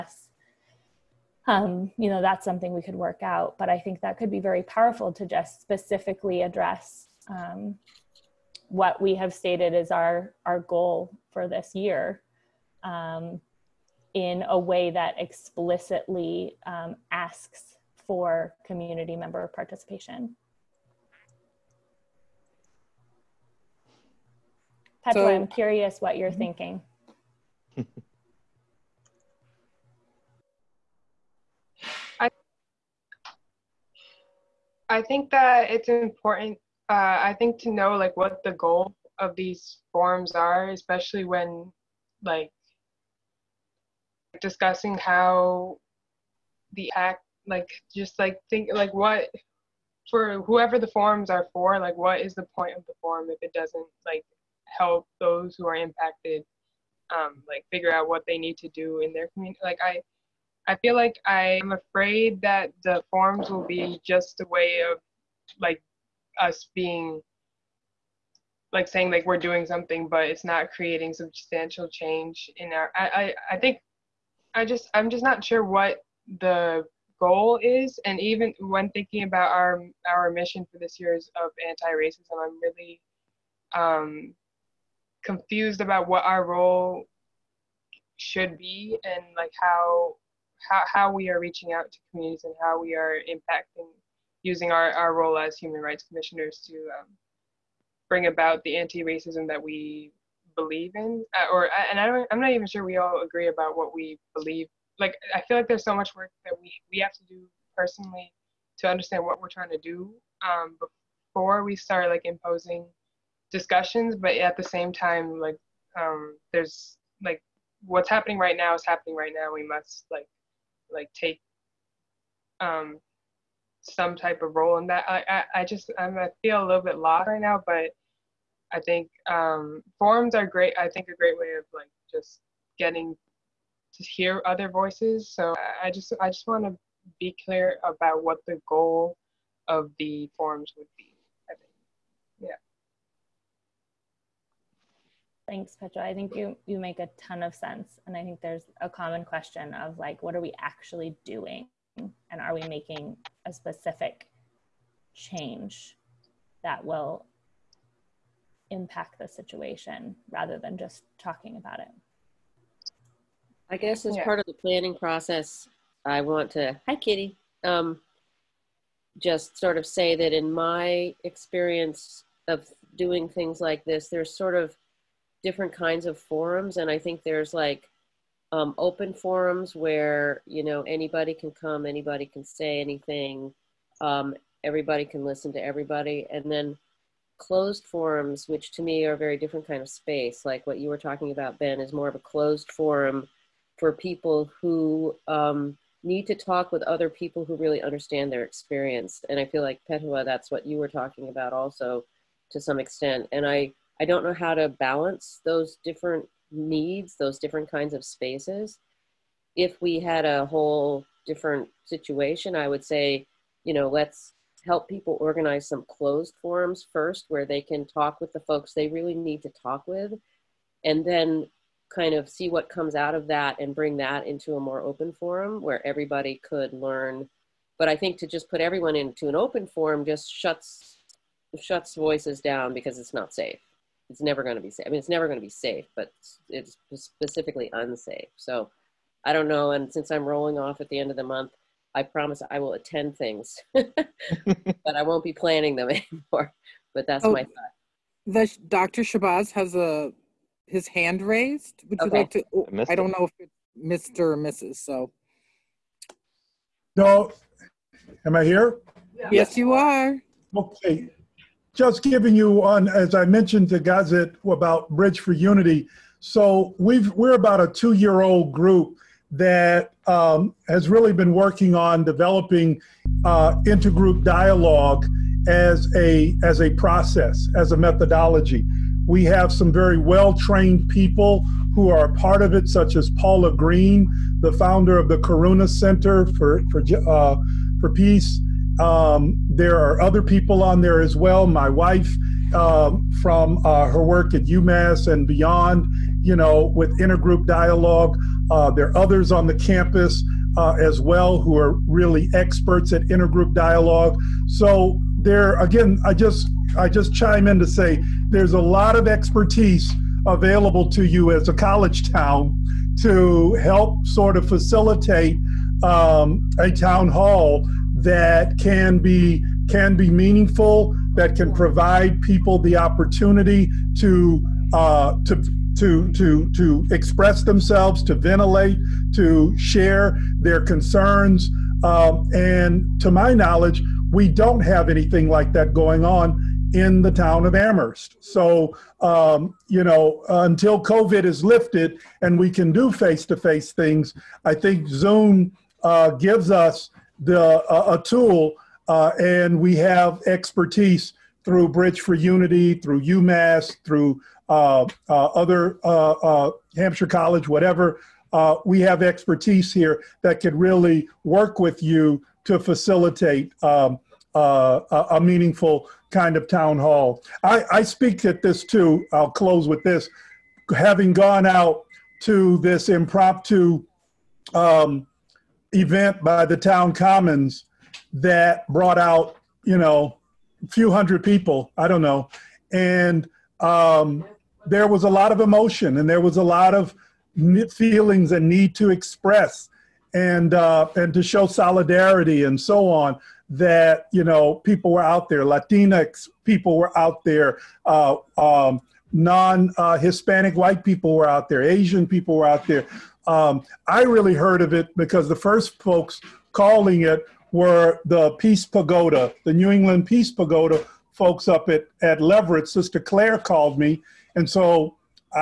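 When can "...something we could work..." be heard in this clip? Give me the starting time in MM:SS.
00:02.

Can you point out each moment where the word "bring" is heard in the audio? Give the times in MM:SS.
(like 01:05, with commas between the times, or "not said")
01:38, 03:43.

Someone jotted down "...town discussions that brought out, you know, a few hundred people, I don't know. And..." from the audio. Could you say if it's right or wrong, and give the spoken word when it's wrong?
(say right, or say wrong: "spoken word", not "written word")
wrong: "commons", not "discussions".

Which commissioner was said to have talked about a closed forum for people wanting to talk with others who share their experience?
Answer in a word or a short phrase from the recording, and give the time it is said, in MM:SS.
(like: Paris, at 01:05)
Ben, at 03:11.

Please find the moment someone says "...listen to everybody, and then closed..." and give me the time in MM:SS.
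03:05.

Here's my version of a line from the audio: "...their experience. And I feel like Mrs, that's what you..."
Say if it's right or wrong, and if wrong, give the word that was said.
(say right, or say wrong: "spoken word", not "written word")
wrong: "Petua", not "Mrs".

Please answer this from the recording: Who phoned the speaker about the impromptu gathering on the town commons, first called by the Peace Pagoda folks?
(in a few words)
Sister Clare.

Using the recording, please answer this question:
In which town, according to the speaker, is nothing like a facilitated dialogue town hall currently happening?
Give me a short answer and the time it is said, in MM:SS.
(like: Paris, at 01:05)
Amherst, at 05:37.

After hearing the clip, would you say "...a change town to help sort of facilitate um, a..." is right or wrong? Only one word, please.
wrong.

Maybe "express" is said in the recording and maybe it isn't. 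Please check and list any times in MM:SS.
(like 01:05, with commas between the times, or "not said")
05:26, 06:28.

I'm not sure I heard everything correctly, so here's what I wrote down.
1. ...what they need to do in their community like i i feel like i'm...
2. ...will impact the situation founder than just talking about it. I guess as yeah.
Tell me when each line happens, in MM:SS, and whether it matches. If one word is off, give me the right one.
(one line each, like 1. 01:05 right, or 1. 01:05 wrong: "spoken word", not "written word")
1. 00:58 right
2. 02:36 wrong: "rather", not "founder".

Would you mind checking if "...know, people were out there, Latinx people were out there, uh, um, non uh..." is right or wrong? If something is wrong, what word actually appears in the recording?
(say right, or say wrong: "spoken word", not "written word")
right.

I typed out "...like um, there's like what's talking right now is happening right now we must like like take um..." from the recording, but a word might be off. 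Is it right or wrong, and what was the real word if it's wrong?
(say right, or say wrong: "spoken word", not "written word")
wrong: "happening", not "talking".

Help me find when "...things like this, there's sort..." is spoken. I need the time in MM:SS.
02:53.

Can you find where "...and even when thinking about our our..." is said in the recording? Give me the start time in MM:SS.
01:18.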